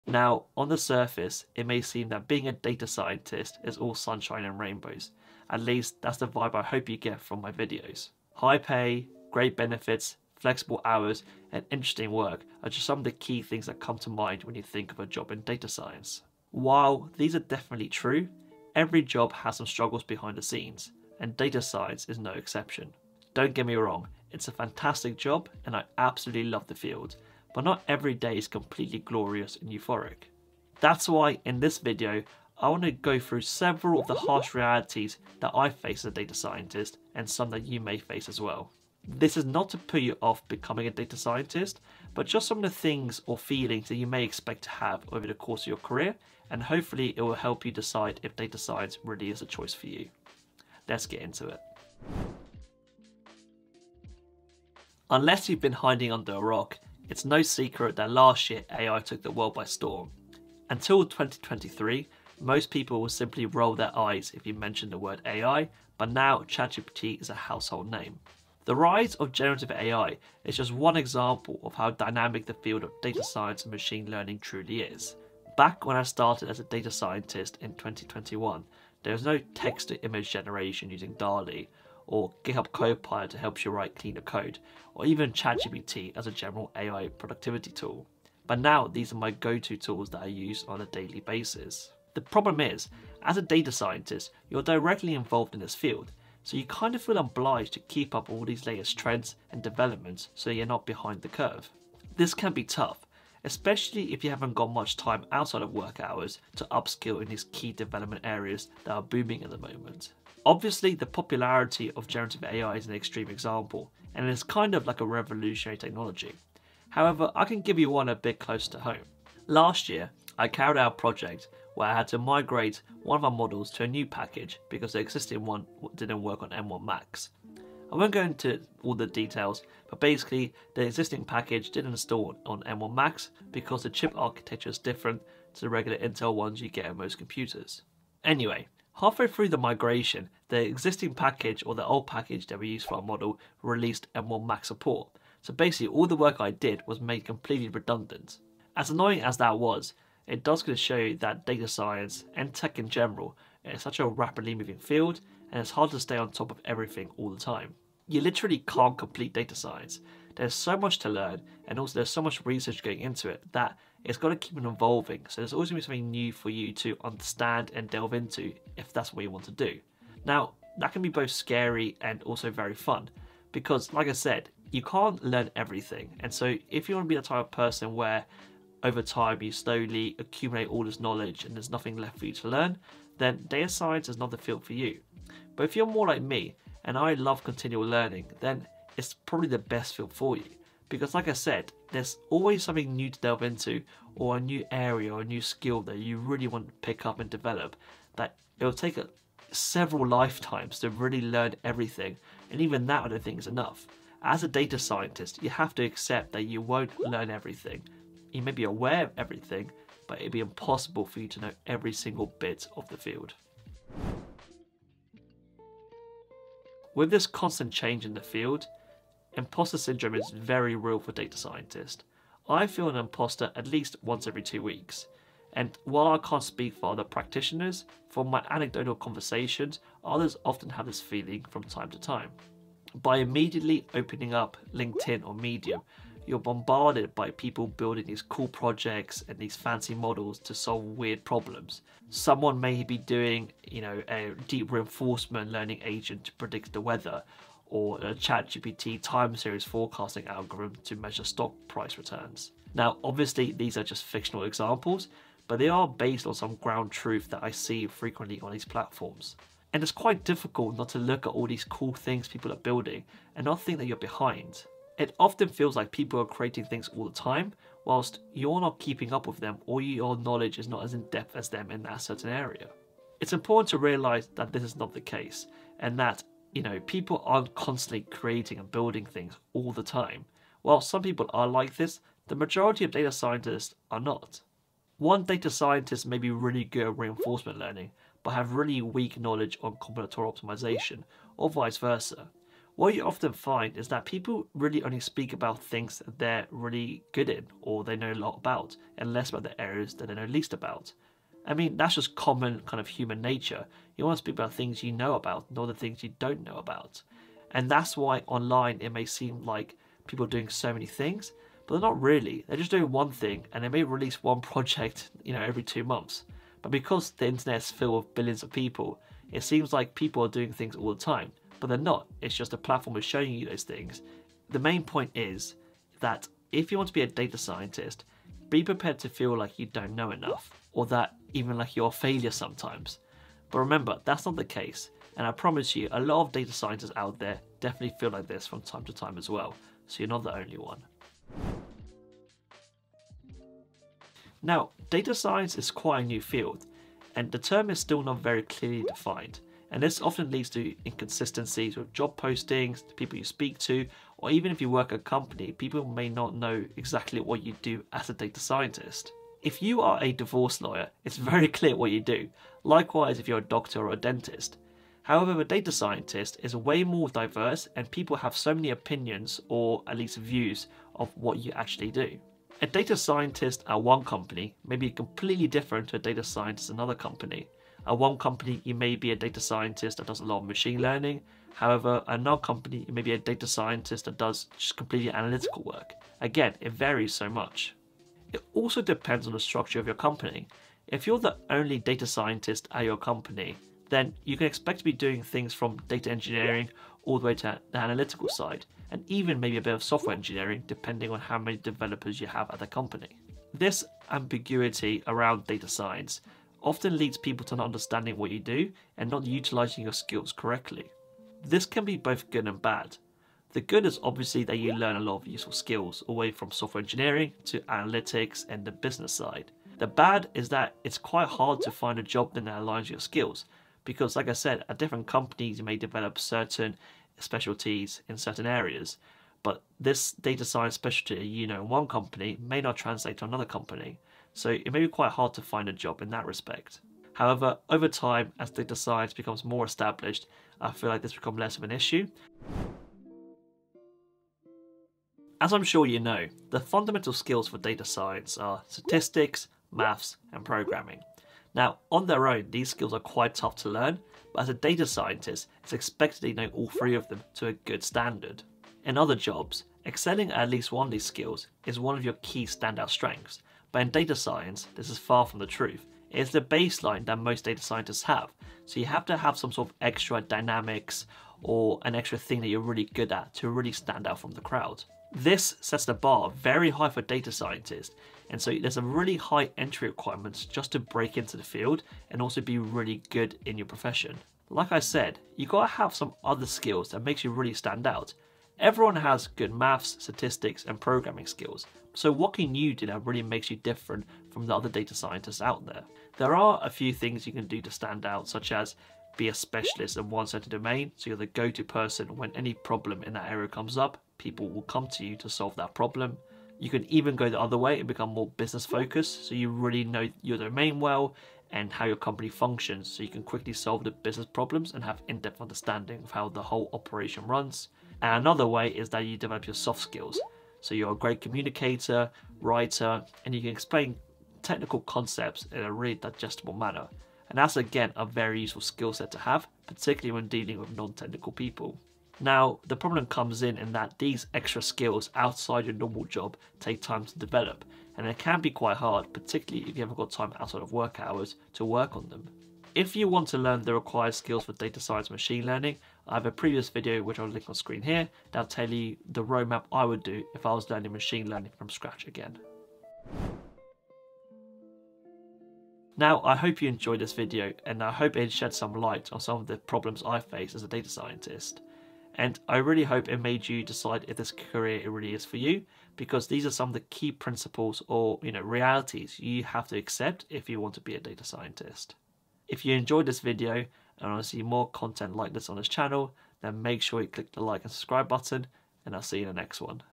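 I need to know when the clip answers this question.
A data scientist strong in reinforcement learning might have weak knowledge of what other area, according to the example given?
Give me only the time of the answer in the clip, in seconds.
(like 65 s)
289 s.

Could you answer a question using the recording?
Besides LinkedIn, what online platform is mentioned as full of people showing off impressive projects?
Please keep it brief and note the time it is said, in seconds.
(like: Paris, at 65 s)
Medium, at 235 s.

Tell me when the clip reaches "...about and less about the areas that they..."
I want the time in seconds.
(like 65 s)
298 s.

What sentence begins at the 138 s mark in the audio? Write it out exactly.
Anyway, halfway through the migration, the existing package or the old package that we used for our model released M1 Max support.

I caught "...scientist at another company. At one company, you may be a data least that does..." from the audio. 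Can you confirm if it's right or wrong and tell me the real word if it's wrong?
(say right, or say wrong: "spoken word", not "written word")
wrong: "scientist", not "least".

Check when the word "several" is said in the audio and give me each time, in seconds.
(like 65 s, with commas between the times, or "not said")
33 s, 199 s.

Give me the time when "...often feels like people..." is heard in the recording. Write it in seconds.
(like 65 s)
265 s.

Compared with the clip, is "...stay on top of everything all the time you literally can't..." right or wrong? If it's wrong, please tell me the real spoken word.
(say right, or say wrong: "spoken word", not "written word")
right.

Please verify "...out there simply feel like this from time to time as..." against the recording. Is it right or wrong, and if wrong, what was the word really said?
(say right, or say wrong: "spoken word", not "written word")
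wrong: "definitely", not "simply".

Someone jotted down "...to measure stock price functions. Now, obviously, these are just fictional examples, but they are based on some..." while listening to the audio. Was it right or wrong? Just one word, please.
wrong.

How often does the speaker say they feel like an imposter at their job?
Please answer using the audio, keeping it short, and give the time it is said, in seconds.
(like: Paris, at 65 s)
Once every two weeks, at 224 s.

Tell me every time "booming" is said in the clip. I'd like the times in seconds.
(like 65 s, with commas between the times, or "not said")
109 s.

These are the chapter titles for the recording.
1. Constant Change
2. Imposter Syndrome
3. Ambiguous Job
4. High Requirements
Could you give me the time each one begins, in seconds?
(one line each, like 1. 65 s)
1. 52 s
2. 214 s
3. 342 s
4. 443 s.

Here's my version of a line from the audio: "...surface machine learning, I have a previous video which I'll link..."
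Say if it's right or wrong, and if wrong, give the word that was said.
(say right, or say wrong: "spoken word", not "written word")
wrong: "science", not "surface".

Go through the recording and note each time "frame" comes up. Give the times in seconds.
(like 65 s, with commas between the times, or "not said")
not said.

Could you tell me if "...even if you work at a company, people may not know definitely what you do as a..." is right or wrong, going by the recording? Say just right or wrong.
wrong.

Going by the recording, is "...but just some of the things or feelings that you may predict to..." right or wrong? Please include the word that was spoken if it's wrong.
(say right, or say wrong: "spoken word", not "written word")
wrong: "expect", not "predict".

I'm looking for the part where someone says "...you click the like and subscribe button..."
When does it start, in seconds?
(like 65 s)
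577 s.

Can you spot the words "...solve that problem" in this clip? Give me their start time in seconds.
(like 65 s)
505 s.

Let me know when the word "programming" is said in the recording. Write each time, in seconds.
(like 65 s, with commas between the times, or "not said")
450 s, 490 s.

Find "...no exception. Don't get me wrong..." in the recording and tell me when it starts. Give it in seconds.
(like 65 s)
22 s.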